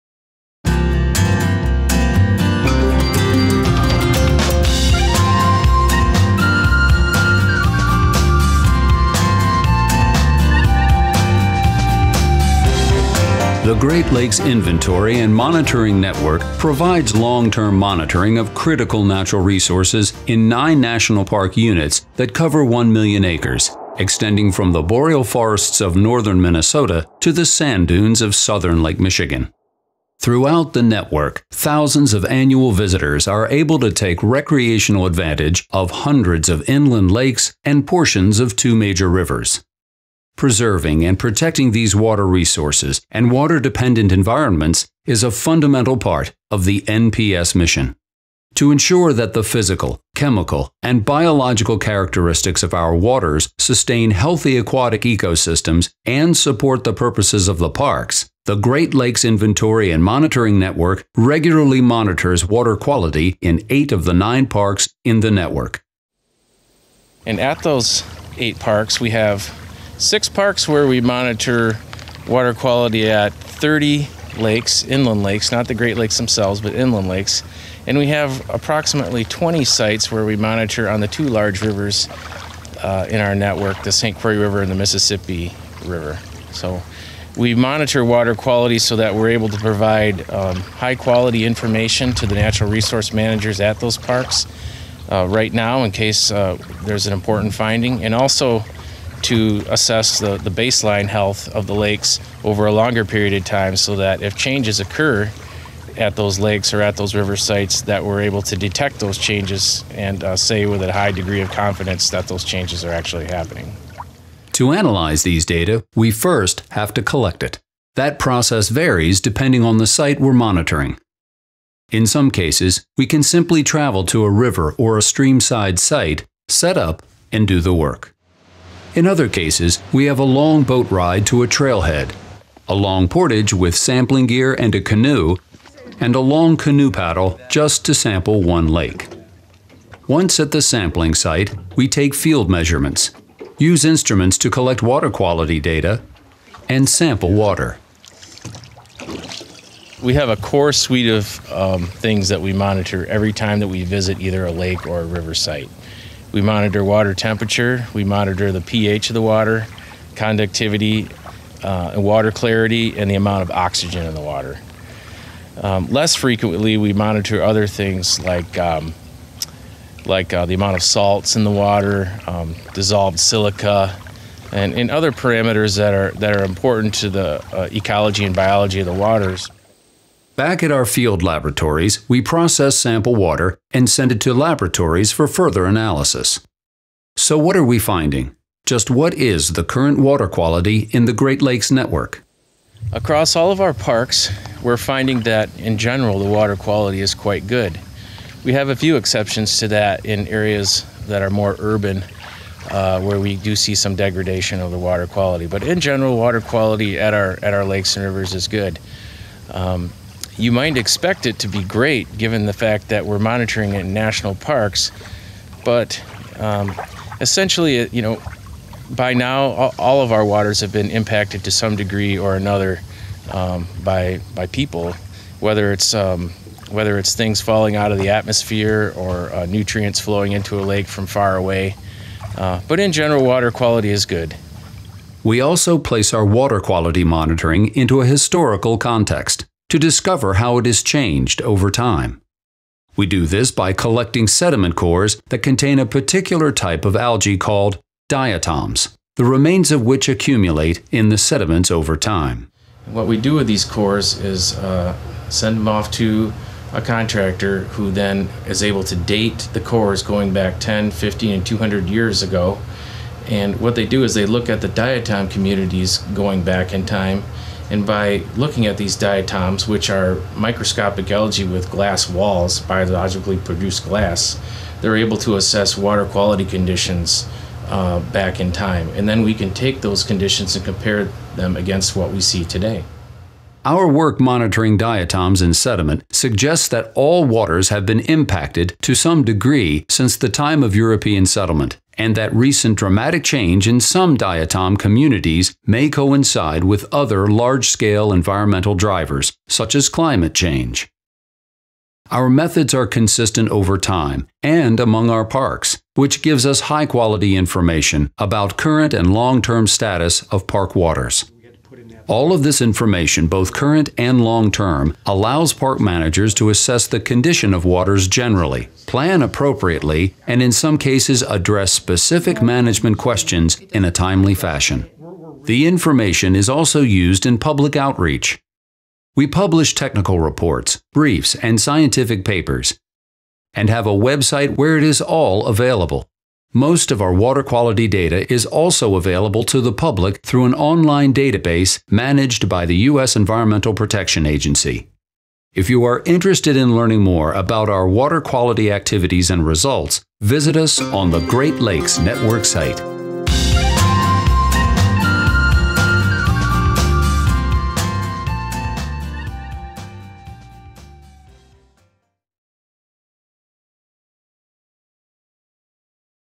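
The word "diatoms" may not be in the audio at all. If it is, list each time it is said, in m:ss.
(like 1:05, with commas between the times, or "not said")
4:08, 4:24, 4:28, 4:44, 4:54.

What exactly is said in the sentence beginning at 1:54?
To analyze these data, we first have to collect it.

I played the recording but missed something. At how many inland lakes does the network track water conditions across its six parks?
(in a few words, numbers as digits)
30.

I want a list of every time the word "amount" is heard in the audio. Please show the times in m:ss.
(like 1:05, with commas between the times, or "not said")
2:43, 2:50.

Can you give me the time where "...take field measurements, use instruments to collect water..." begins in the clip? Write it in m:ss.
2:21.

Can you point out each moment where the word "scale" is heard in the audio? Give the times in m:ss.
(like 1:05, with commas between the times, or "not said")
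4:57.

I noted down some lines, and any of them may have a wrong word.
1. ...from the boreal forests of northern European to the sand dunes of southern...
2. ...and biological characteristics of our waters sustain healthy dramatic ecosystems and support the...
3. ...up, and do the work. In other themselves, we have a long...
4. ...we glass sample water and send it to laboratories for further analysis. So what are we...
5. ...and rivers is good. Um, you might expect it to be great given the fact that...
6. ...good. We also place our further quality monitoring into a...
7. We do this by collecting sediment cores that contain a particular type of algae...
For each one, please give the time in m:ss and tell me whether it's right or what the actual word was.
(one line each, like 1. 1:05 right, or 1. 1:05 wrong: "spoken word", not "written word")
1. 0:24 wrong: "Minnesota", not "European"
2. 0:50 wrong: "aquatic", not "dramatic"
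3. 2:06 wrong: "cases", not "themselves"
4. 3:02 wrong: "process", not "glass"
5. 3:27 right
6. 3:54 wrong: "water", not "further"
7. 4:02 right.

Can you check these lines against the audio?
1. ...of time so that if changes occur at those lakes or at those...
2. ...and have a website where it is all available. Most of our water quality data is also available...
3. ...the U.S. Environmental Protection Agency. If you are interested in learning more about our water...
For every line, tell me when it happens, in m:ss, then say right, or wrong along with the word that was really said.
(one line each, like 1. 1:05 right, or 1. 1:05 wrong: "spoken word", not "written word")
1. 1:43 right
2. 5:33 right
3. 5:42 right.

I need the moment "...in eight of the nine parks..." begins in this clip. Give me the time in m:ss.
1:03.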